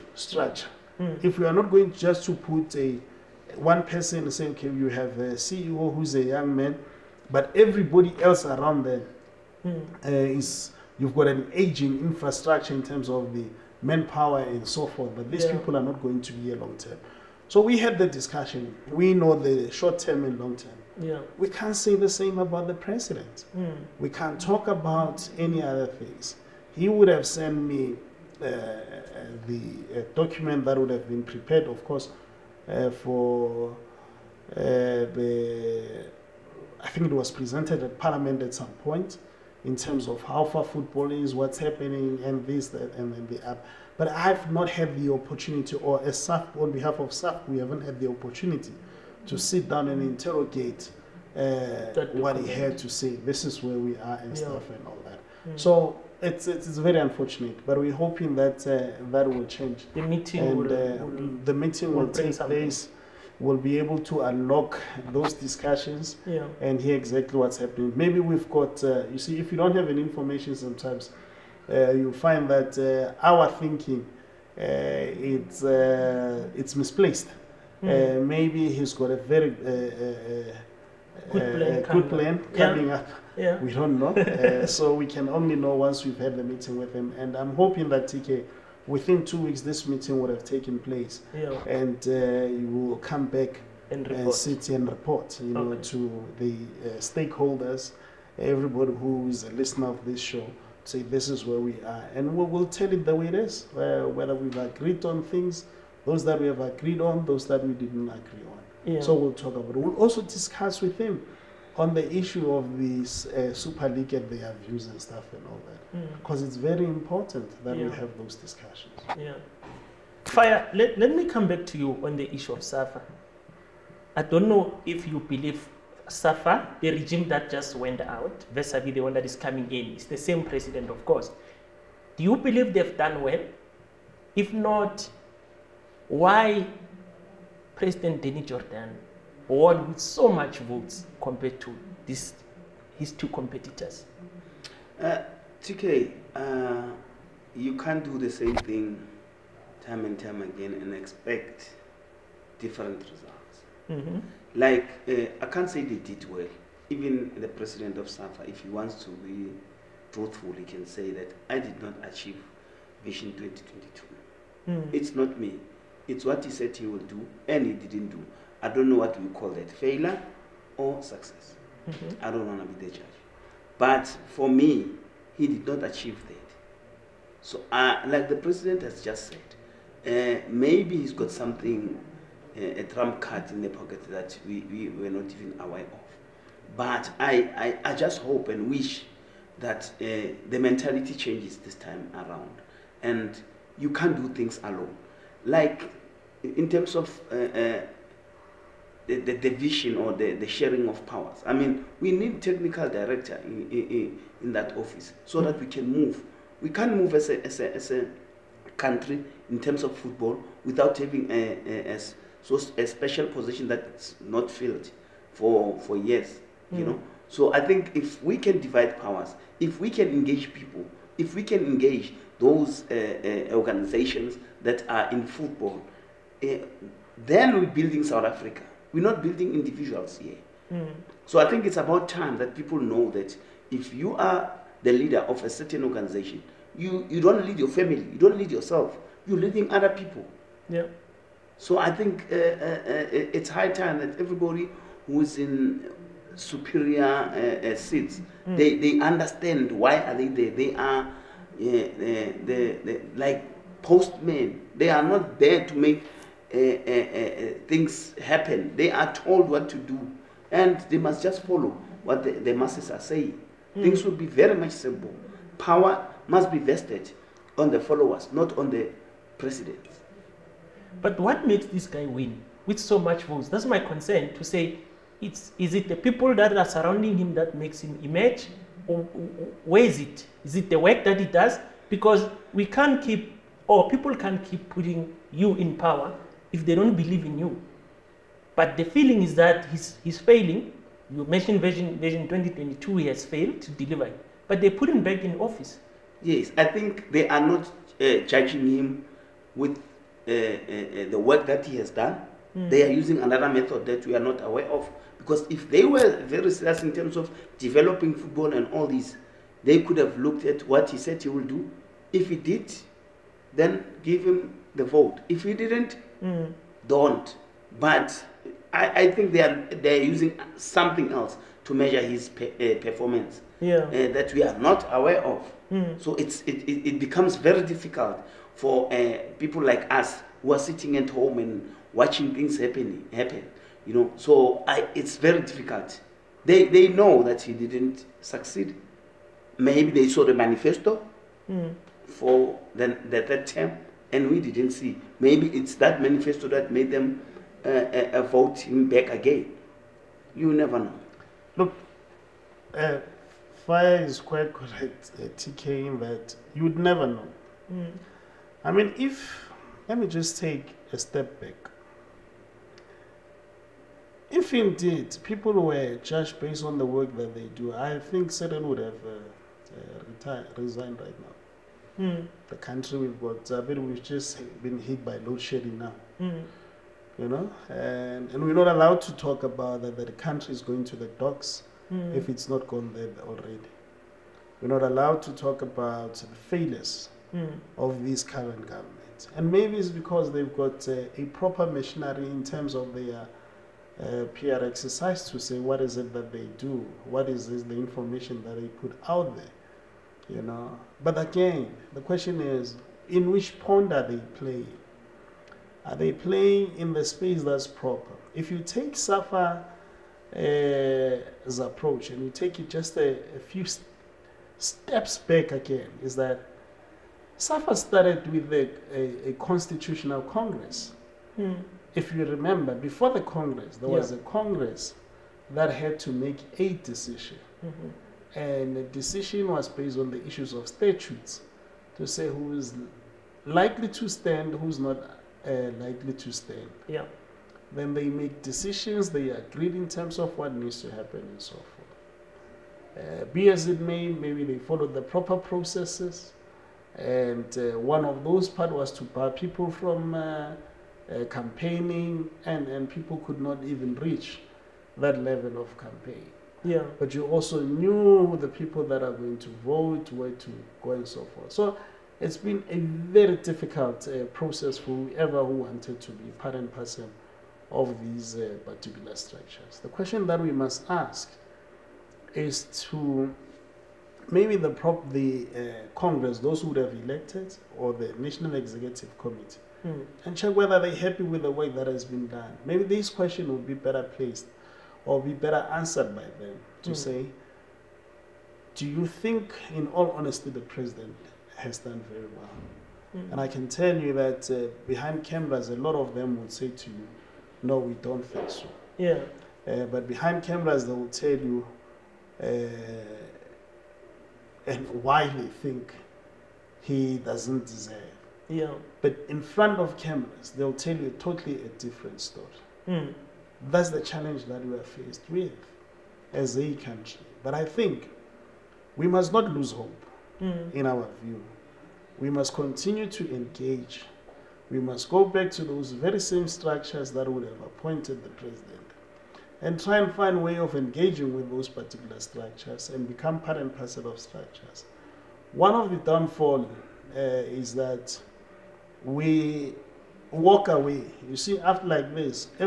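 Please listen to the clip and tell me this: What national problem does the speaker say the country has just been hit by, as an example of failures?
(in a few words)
Load shedding.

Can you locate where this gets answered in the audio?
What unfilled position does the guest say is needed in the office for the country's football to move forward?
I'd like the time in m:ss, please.
3:22.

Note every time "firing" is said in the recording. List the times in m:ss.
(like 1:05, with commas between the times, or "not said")
not said.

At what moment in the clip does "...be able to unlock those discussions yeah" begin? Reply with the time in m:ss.
1:03.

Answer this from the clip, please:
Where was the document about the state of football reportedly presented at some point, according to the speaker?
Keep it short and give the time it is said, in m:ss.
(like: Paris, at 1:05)
Parliament, at 0:37.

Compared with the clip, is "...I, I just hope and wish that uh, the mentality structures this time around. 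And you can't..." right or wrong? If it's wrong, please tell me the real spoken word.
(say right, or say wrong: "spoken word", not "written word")
wrong: "changes", not "structures".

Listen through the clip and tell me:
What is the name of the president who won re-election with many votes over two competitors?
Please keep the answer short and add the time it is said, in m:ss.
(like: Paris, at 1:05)
Denis Jordaan, at 2:18.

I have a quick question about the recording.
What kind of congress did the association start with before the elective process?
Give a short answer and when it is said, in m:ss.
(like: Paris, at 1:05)
Constitutional congress, at 6:59.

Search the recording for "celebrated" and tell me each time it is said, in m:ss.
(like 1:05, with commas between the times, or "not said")
not said.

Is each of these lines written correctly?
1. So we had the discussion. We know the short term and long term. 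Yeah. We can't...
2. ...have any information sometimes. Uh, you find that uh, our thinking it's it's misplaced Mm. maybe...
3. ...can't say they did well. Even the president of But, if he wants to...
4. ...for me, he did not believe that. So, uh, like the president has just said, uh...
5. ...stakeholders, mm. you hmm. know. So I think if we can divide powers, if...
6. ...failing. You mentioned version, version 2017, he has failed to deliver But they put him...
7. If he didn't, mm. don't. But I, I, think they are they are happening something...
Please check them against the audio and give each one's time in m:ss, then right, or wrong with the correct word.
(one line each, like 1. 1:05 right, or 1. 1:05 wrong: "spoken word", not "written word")
1. 0:17 right
2. 1:09 right
3. 2:35 wrong: "SAFA", not "But"
4. 2:54 wrong: "achieve", not "believe"
5. 3:35 wrong: "years", not "stakeholders"
6. 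4:50 wrong: "2022", not "2017"
7. 5:15 wrong: "using", not "happening".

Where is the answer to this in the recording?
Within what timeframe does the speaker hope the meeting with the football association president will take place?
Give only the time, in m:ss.
1:29.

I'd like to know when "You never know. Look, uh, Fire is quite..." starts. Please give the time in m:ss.
5:50.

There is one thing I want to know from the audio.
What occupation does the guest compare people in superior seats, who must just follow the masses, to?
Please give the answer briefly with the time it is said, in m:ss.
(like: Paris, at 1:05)
Postmen, at 4:13.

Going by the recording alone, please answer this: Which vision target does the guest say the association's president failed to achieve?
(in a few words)
Vision 2022.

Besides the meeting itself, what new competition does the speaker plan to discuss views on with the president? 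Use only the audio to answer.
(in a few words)
Super League.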